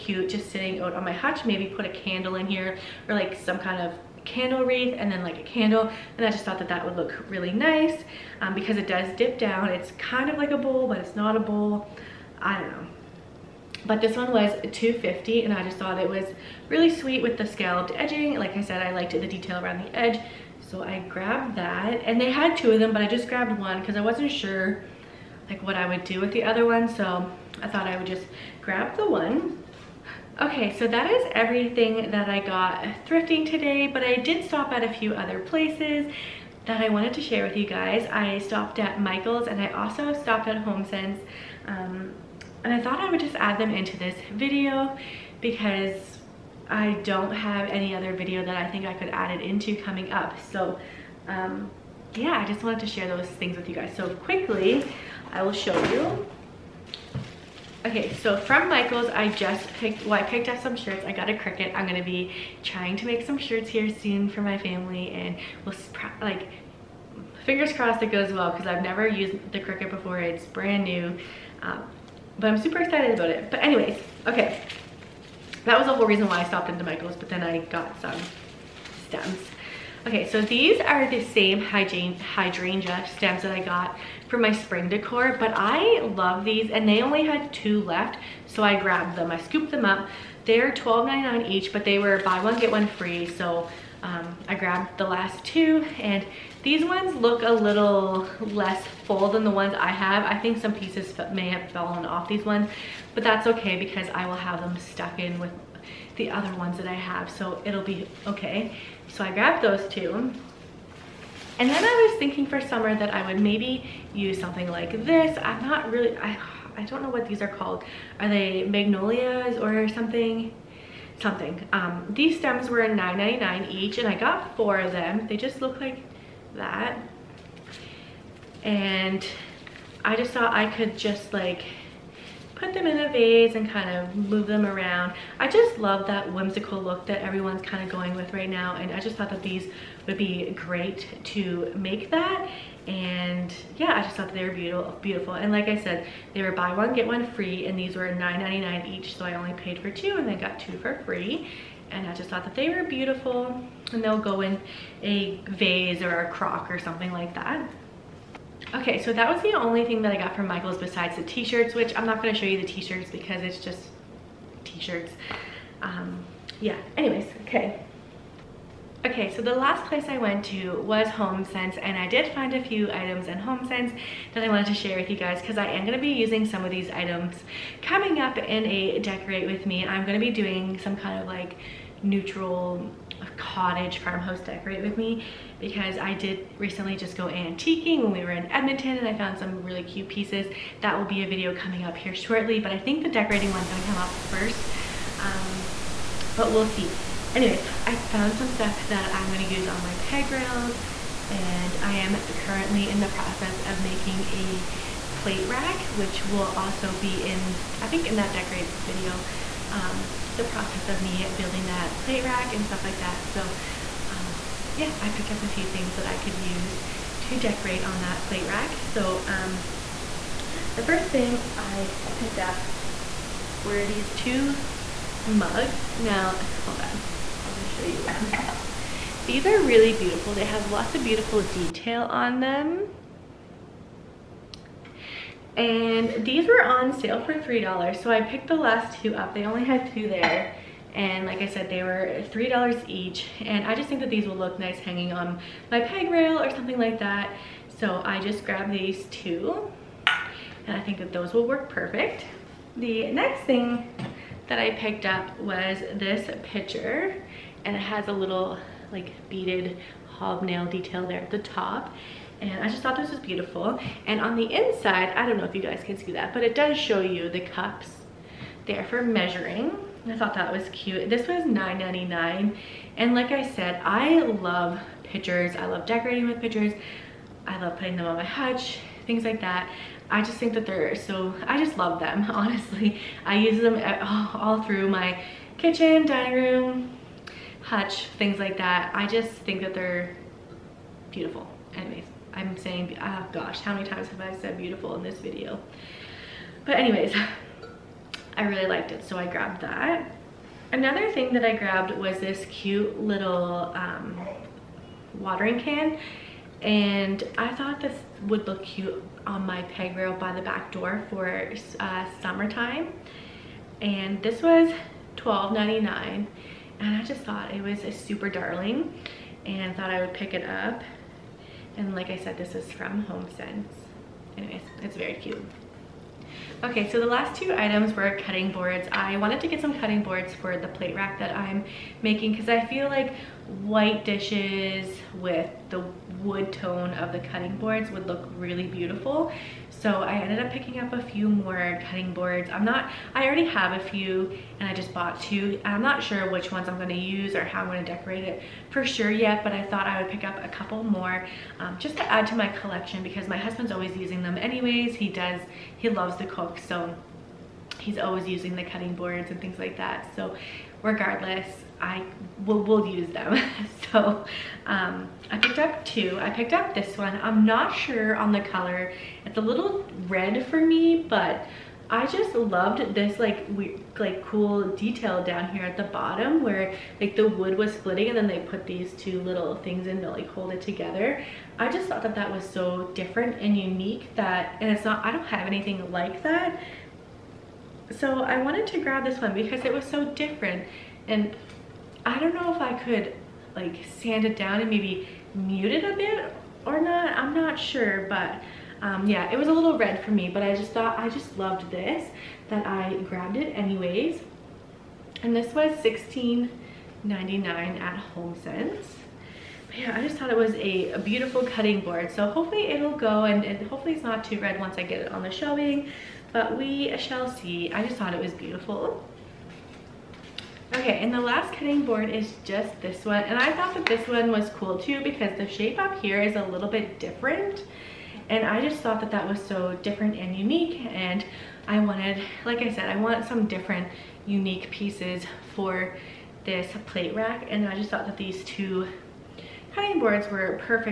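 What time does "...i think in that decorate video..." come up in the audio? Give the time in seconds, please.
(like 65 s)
207 s.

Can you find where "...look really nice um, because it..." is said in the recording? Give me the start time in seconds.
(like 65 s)
6 s.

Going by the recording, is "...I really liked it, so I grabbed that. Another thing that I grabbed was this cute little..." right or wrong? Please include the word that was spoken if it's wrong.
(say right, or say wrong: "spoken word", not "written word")
right.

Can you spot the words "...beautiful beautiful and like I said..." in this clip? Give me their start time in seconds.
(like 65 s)
144 s.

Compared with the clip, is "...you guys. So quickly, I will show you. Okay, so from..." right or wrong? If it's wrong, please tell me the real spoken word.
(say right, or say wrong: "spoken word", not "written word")
right.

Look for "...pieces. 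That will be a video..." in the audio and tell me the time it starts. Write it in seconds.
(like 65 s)
190 s.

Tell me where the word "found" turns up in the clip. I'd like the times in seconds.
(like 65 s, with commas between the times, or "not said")
189 s, 198 s.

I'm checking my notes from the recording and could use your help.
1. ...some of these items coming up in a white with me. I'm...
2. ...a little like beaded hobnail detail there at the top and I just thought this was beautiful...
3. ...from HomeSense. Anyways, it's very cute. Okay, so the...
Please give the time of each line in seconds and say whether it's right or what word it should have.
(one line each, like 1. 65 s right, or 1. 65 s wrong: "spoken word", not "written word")
1. 176 s wrong: "decorate", not "white"
2. 258 s right
3. 322 s right.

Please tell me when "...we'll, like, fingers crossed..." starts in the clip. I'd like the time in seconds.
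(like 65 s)
65 s.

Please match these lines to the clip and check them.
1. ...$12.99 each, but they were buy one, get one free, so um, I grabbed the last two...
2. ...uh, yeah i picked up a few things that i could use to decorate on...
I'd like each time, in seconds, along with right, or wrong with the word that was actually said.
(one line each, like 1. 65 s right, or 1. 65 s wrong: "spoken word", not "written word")
1. 90 s right
2. 214 s right.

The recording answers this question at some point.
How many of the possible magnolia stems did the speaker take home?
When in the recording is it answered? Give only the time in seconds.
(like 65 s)
124 s.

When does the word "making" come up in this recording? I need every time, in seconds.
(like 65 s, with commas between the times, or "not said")
203 s, 332 s.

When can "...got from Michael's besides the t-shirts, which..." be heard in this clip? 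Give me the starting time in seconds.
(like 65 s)
160 s.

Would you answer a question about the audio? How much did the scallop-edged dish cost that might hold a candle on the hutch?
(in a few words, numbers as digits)
250.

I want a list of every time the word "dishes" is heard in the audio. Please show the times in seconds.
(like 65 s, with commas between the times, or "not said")
334 s.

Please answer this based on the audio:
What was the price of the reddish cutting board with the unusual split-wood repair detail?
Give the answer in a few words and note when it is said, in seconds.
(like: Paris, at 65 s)
$16.99, at 405 s.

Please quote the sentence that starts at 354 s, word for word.
He does, he loves to cook, so he's always using the cutting boards and things like that.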